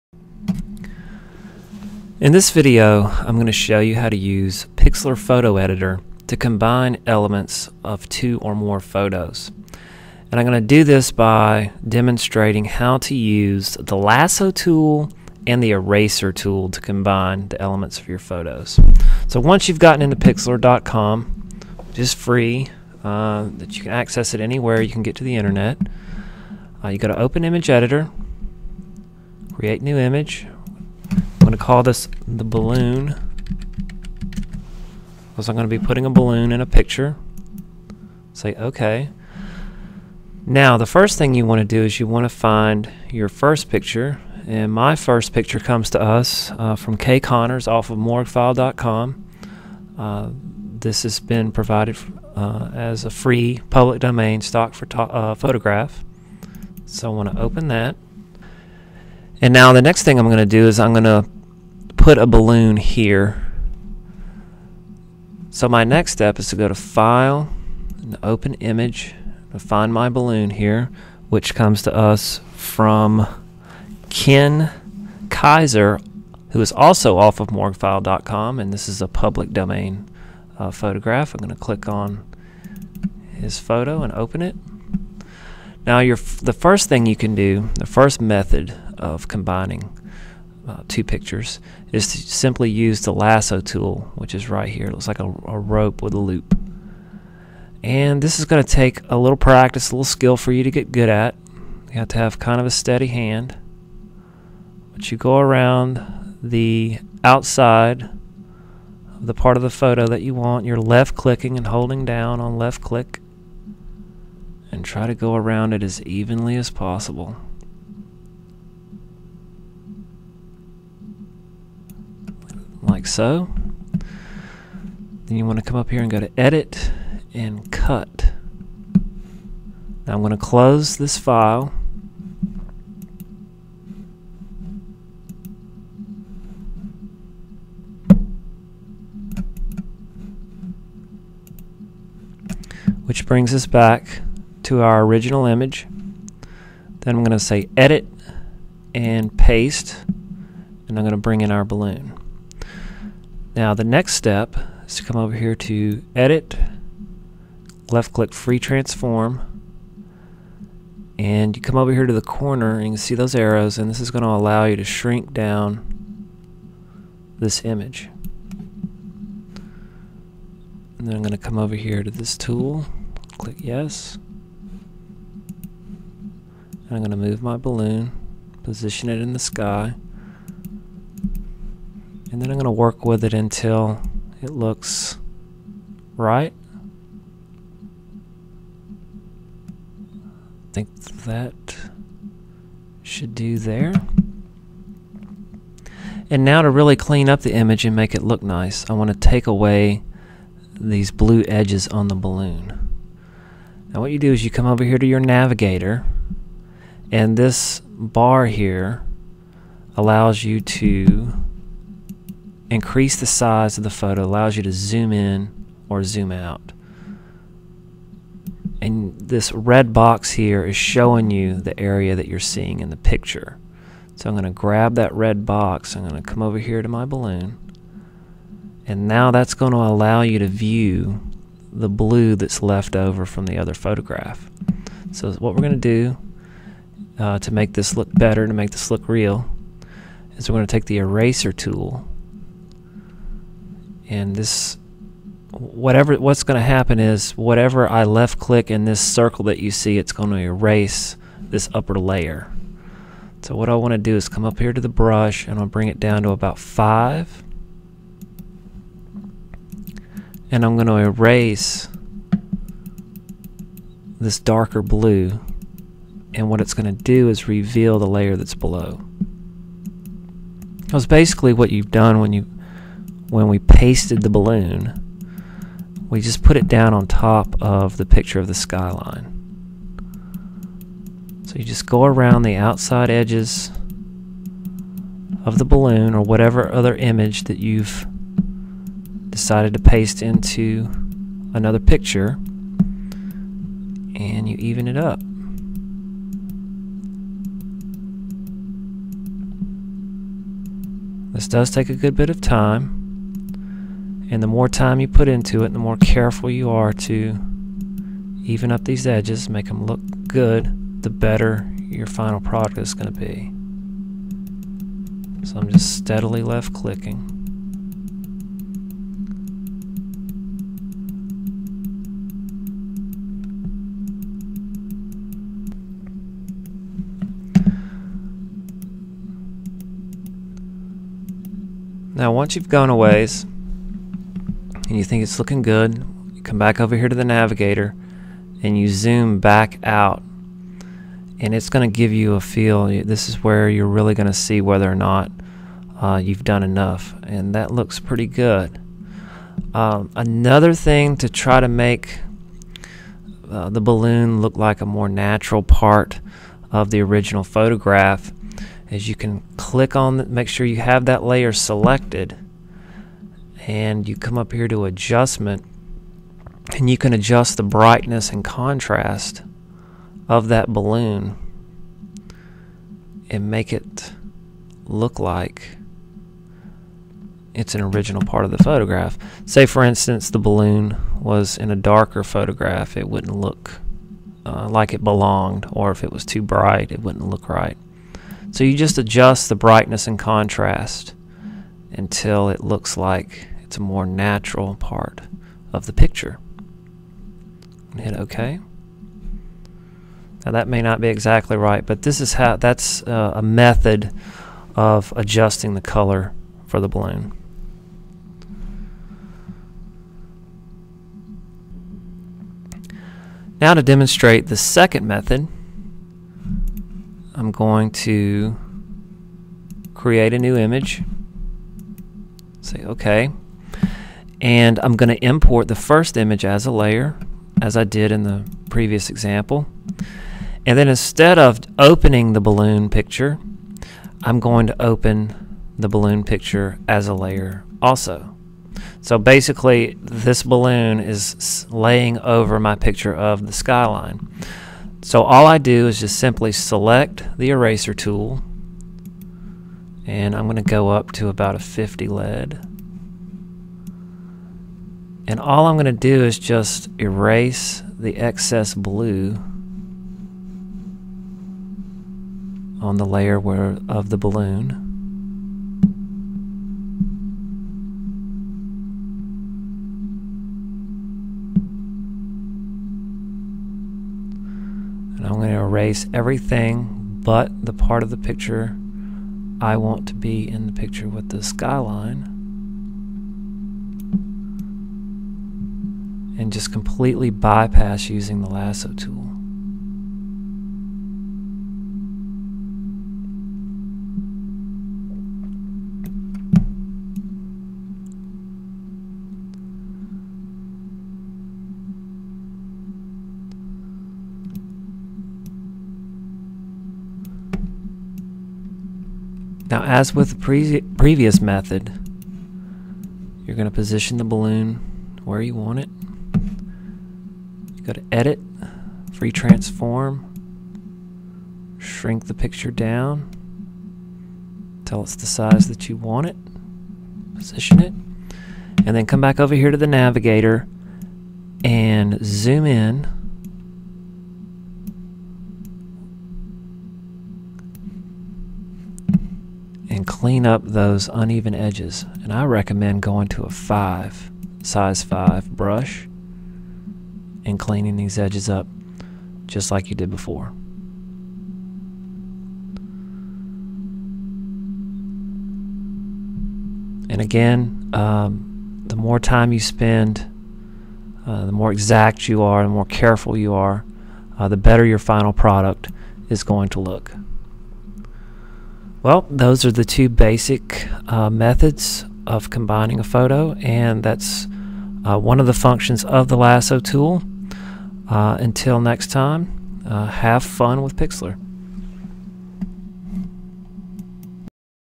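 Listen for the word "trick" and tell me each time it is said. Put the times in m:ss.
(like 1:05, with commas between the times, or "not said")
not said.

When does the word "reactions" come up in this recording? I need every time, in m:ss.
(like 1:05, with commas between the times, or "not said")
not said.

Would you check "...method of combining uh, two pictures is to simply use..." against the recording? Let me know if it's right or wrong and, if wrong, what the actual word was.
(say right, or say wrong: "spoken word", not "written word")
right.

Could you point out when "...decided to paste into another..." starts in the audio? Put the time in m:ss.
4:49.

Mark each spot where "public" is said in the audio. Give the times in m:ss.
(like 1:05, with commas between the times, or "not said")
0:53, 1:19.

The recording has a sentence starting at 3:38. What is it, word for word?
And this red box here is showing you the area that you're seeing in the picture.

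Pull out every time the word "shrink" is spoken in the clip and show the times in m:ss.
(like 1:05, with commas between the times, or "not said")
2:44, 8:41.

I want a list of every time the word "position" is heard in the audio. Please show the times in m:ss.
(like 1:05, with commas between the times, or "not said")
2:58, 8:33, 8:47.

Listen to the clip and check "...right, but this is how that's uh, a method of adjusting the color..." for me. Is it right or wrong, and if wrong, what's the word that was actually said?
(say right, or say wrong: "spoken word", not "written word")
right.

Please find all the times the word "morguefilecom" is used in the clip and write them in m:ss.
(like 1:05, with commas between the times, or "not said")
0:47, 1:17.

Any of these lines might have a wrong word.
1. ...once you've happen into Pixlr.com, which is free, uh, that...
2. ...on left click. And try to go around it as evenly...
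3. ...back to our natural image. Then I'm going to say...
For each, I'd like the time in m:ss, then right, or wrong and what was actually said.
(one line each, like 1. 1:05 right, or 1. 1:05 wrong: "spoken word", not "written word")
1. 0:19 wrong: "gotten", not "happen"
2. 1:52 right
3. 2:23 wrong: "original", not "natural".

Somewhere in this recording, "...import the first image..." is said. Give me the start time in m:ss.
7:05.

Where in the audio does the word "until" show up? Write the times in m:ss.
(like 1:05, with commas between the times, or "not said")
3:03, 6:31, 9:38.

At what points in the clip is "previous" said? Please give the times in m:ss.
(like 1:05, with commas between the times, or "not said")
7:08, 8:30.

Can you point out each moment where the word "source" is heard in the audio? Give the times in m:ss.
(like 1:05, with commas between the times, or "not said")
not said.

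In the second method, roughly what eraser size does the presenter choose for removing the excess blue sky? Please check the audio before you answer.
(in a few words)
50.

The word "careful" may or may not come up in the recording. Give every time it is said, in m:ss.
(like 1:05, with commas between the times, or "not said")
5:05, 9:22.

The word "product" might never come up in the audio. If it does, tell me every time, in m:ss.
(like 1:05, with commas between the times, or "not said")
5:12, 9:25.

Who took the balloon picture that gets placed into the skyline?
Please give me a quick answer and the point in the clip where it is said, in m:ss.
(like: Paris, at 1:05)
Ken Kaiser, at 1:14.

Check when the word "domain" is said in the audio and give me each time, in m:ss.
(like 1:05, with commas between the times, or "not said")
0:53, 1:19.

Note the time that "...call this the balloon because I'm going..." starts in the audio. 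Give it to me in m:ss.
0:31.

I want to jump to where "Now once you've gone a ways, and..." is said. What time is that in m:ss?
5:32.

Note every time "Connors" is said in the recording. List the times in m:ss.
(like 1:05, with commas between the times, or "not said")
0:47.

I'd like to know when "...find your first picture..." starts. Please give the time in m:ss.
0:42.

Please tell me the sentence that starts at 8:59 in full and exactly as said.
and clean up those uneven edges.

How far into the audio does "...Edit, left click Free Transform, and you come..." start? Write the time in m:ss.
2:36.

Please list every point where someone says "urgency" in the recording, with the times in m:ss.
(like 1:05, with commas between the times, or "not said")
not said.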